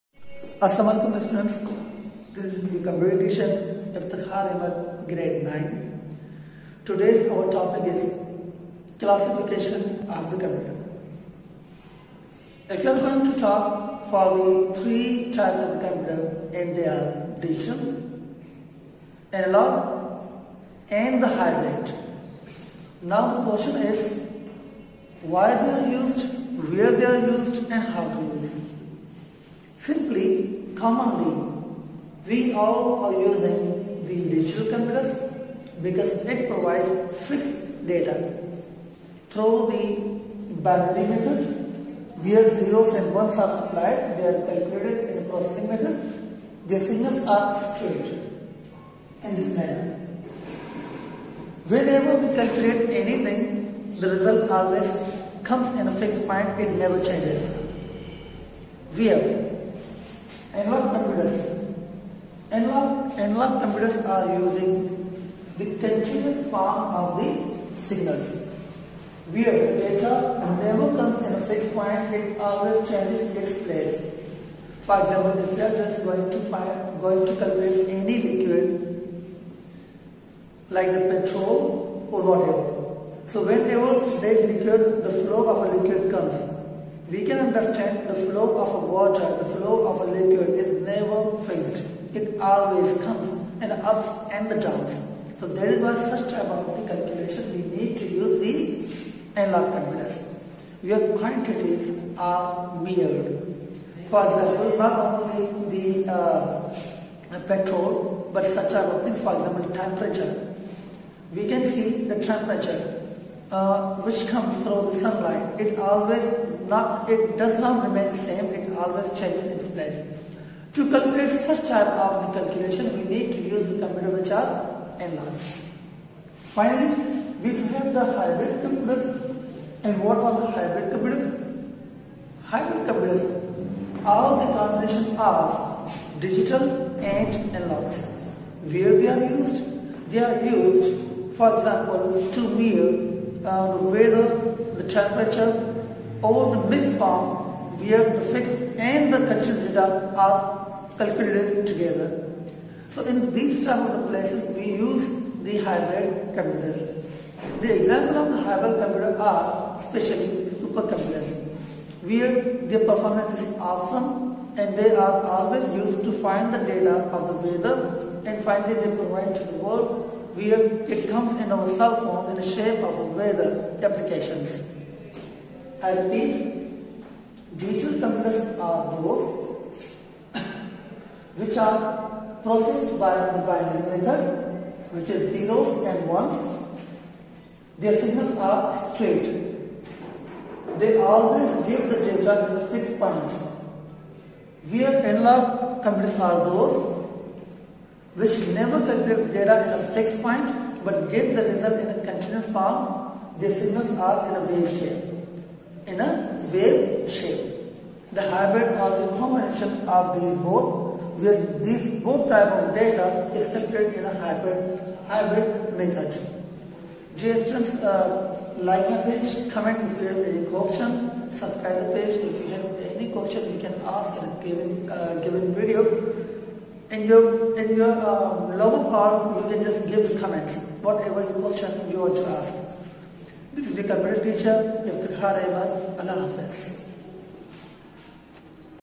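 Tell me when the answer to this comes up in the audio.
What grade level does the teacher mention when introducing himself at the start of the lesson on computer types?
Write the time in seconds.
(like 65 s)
5 s.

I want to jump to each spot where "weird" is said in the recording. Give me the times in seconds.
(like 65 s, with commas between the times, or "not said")
102 s.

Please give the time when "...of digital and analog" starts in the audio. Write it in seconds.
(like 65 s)
135 s.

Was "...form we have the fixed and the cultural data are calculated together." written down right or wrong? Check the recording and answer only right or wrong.
right.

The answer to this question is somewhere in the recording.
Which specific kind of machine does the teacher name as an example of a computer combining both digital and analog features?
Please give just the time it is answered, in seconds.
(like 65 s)
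160 s.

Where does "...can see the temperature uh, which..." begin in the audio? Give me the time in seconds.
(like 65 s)
111 s.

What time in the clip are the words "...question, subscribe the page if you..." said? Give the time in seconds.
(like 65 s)
220 s.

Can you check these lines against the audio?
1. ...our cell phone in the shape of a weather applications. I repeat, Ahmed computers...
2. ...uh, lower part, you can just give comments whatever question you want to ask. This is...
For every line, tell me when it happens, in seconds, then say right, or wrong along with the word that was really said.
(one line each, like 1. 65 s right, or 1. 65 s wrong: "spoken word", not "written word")
1. 171 s wrong: "Digital", not "Ahmed"
2. 227 s right.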